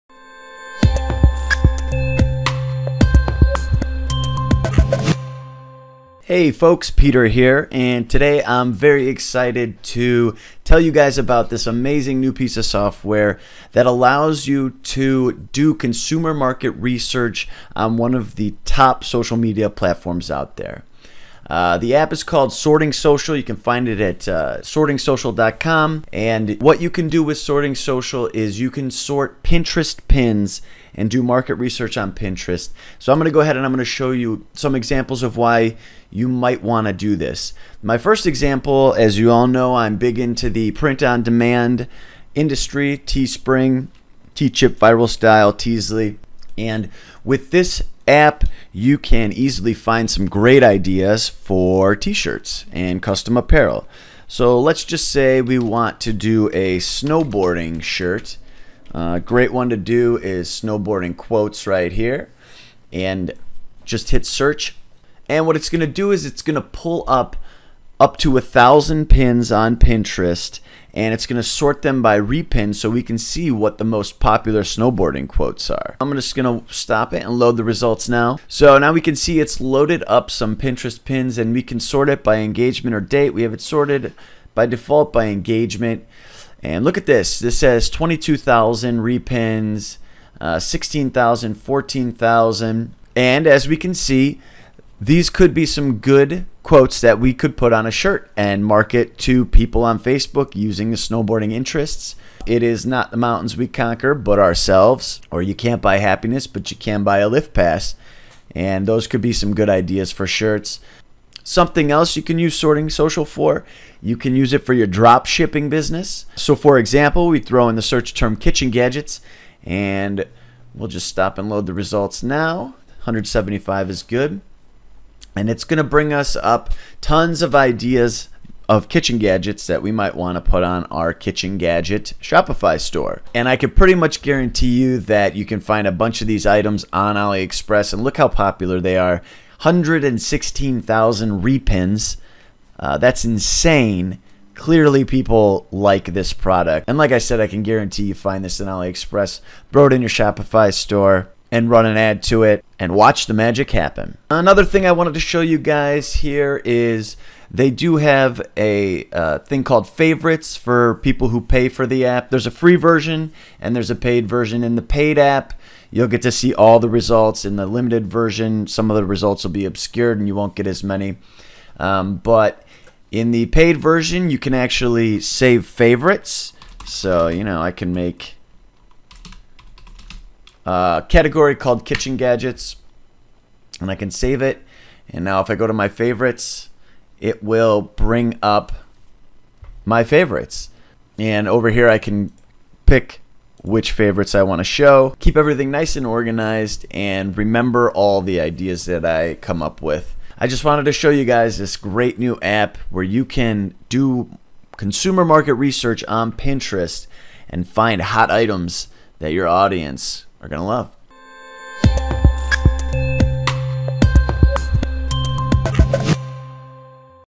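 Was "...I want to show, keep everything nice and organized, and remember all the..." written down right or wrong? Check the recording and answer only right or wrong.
right.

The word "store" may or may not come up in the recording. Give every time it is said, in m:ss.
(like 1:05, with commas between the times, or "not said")
2:12, 2:30.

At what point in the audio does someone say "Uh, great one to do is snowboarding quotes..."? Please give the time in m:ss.
0:58.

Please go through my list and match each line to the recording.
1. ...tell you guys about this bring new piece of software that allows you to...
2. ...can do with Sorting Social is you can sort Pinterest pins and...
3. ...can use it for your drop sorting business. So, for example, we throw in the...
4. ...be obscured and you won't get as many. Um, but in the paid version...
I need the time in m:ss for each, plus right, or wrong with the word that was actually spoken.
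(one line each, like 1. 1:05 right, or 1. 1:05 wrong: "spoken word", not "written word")
1. 0:10 wrong: "amazing", not "bring"
2. 0:26 right
3. 1:54 wrong: "shipping", not "sorting"
4. 2:49 right.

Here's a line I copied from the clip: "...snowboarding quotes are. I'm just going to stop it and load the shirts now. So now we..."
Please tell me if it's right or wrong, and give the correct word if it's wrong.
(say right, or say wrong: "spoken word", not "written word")
wrong: "results", not "shirts".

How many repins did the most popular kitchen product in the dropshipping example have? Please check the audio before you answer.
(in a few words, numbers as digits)
116,000.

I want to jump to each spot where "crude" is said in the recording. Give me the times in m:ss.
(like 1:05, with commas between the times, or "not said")
not said.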